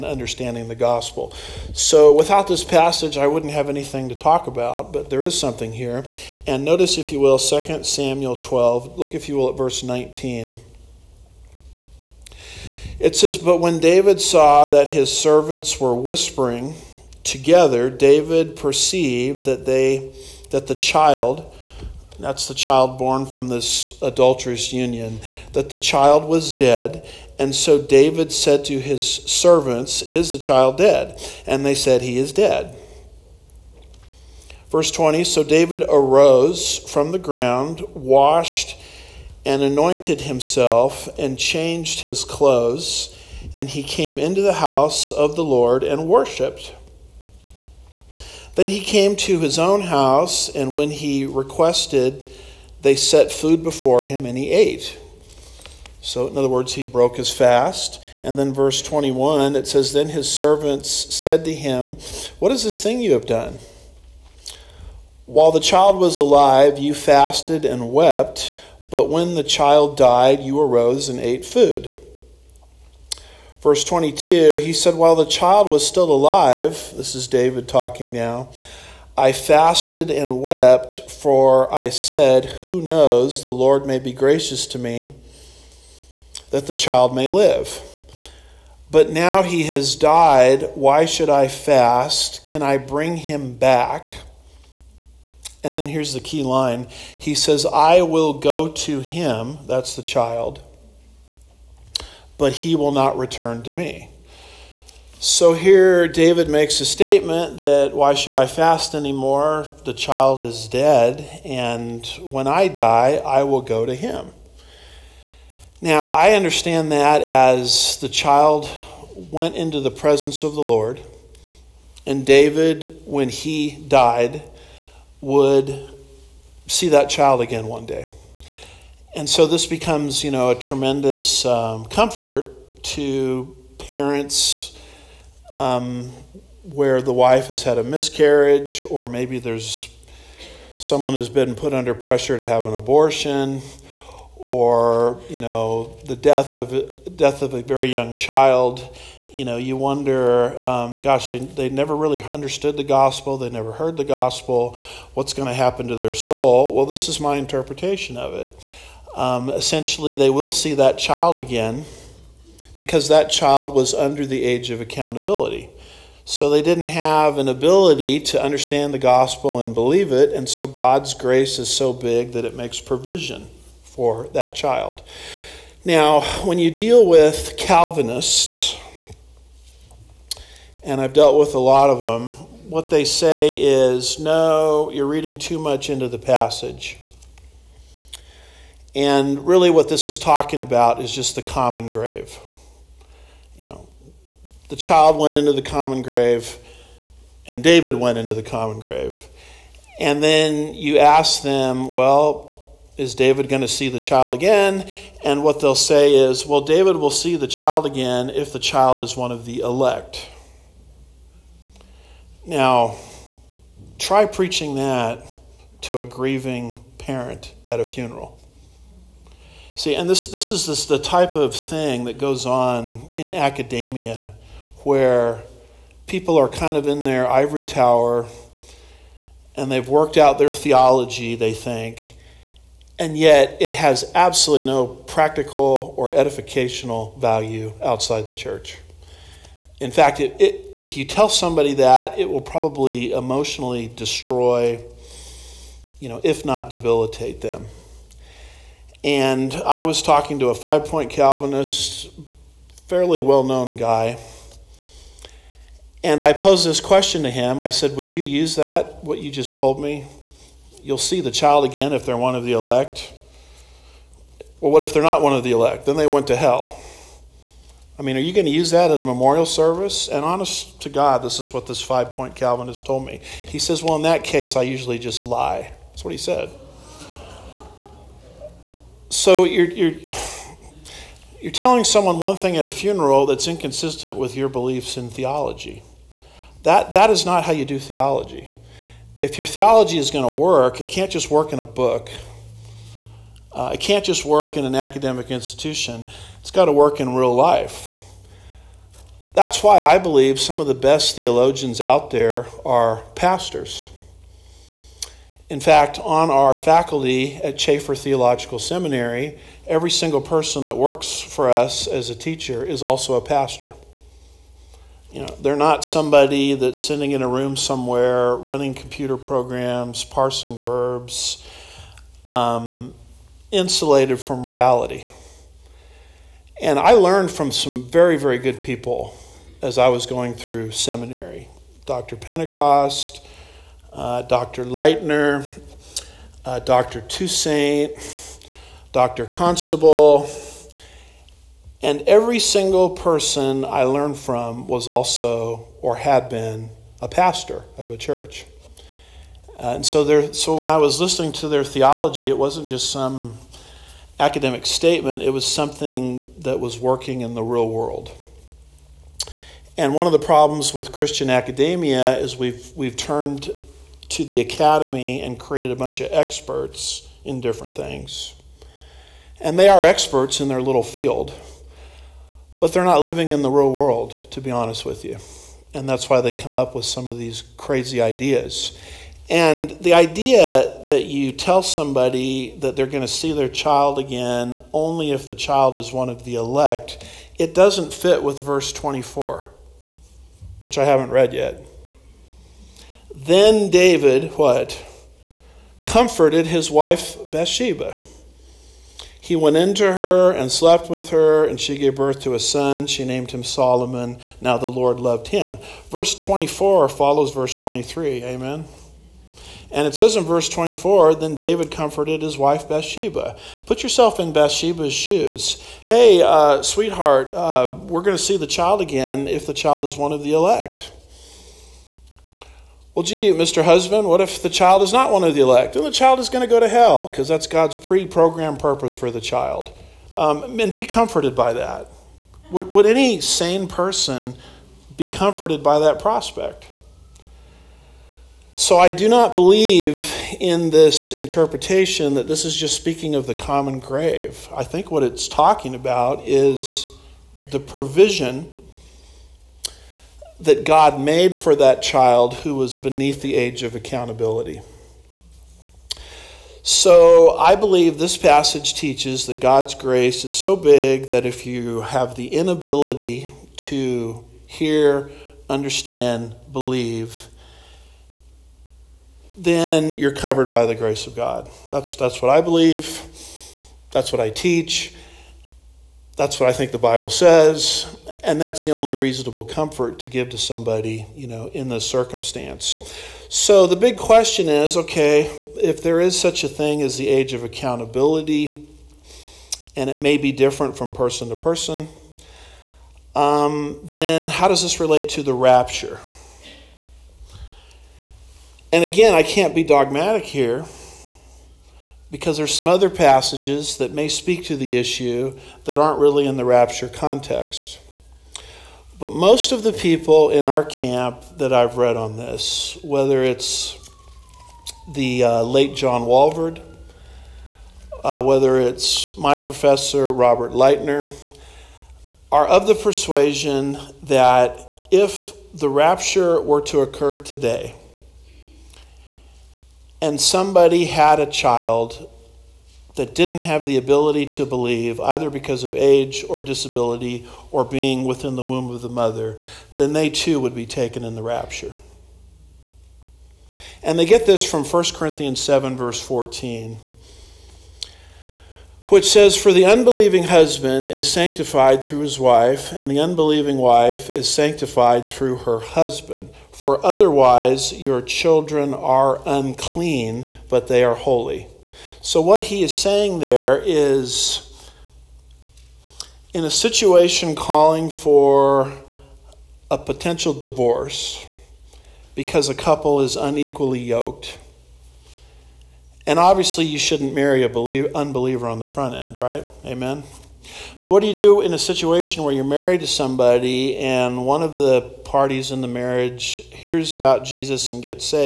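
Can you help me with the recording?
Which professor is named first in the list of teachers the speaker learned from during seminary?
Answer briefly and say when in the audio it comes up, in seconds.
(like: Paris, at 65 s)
Dr. Pentecost, at 331 s.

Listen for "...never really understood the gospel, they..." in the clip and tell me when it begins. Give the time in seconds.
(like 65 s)
151 s.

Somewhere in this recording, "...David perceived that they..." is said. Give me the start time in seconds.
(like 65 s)
17 s.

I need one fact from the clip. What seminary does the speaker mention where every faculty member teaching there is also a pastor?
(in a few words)
Chafer Theological Seminary.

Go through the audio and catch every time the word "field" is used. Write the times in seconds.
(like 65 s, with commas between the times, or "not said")
370 s.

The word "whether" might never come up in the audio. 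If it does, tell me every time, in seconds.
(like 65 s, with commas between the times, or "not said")
512 s, 518 s.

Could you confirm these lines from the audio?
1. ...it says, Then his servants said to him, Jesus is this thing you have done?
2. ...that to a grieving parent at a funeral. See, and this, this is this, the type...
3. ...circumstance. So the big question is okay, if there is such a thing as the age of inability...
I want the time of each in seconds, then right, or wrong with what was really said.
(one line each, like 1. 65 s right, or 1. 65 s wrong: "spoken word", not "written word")
1. 59 s wrong: "What", not "Jesus"
2. 214 s right
3. 481 s wrong: "accountability", not "inability".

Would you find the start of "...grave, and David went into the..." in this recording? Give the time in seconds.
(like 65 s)
196 s.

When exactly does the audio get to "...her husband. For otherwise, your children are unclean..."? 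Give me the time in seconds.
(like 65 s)
555 s.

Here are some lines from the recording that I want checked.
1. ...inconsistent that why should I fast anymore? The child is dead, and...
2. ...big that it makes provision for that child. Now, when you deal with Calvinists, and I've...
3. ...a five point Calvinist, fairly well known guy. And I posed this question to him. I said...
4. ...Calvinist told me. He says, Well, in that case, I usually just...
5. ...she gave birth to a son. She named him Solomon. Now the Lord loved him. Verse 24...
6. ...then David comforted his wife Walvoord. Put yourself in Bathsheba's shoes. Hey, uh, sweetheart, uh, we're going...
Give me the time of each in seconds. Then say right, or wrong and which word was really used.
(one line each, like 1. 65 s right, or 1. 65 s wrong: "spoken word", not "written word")
1. 106 s wrong: "statement", not "inconsistent"
2. 171 s right
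3. 250 s right
4. 272 s right
5. 401 s right
6. 411 s wrong: "Bathsheba", not "Walvoord".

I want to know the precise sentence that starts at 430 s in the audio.
Um, and be comforted by that.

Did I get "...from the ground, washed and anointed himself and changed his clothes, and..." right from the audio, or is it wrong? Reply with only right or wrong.
right.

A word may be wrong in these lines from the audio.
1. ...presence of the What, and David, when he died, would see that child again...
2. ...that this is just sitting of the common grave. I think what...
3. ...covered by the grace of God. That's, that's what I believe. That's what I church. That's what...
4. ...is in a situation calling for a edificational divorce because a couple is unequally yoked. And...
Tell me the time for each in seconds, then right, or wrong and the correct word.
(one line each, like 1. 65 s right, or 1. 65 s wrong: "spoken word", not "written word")
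1. 119 s wrong: "Lord", not "What"
2. 442 s wrong: "speaking", not "sitting"
3. 470 s wrong: "teach", not "church"
4. 563 s wrong: "potential", not "edificational".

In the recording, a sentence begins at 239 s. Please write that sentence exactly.
In fact, it, it, if you tell somebody that, it will probably emotionally destroy, you know, if not debilitate them.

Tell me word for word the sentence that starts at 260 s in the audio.
You'll see the child again if they're one of the elect.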